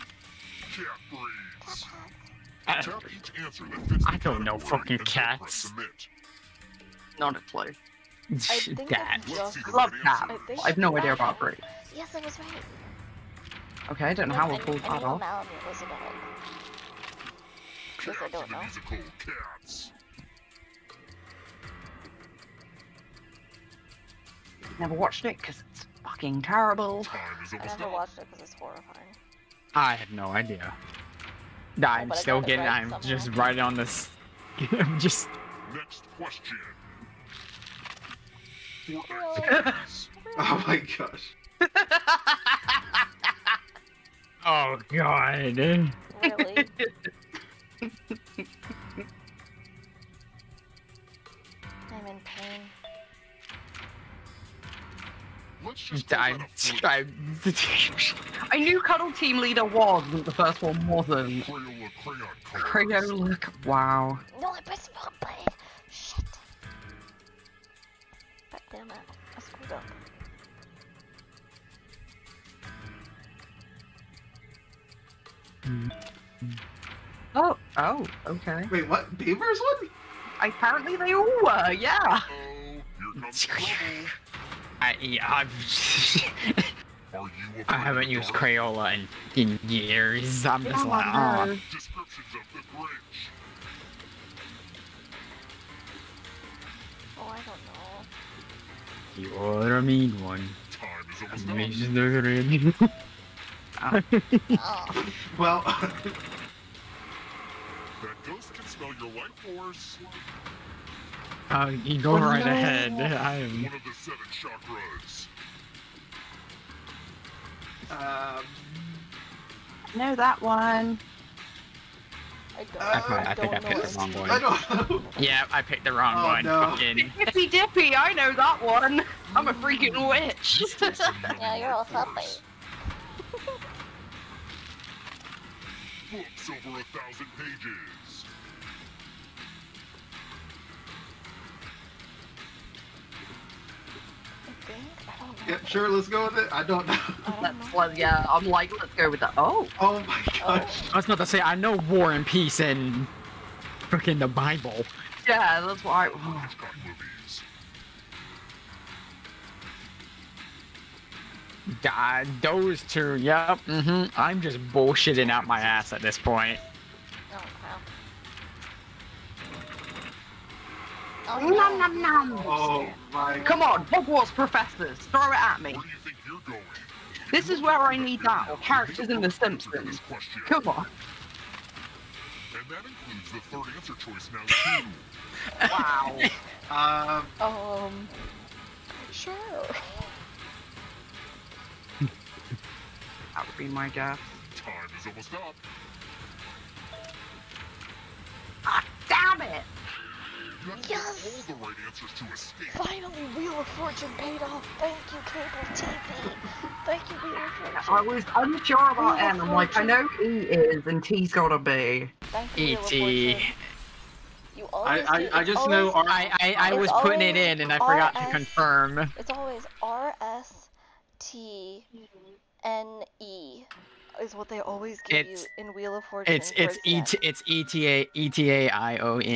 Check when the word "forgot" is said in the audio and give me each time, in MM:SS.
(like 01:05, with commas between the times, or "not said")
03:37.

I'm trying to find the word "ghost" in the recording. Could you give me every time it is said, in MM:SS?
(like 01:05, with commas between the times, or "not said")
01:48.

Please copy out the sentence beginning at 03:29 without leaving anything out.
I'm like, I know E is, and T's gotta be.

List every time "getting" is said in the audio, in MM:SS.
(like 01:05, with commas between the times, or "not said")
00:32.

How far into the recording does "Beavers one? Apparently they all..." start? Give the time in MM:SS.
01:19.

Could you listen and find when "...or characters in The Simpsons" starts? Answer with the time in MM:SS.
02:58.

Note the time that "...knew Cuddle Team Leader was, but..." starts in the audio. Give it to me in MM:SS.
00:58.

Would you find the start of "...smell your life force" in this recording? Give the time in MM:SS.
01:48.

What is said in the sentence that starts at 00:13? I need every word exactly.
Okay, I don't know no, how we'll pull that off.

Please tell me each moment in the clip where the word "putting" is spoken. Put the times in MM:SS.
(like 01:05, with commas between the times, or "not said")
03:37.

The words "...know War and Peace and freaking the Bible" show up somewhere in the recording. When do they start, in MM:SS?
02:31.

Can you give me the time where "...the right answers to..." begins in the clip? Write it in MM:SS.
03:21.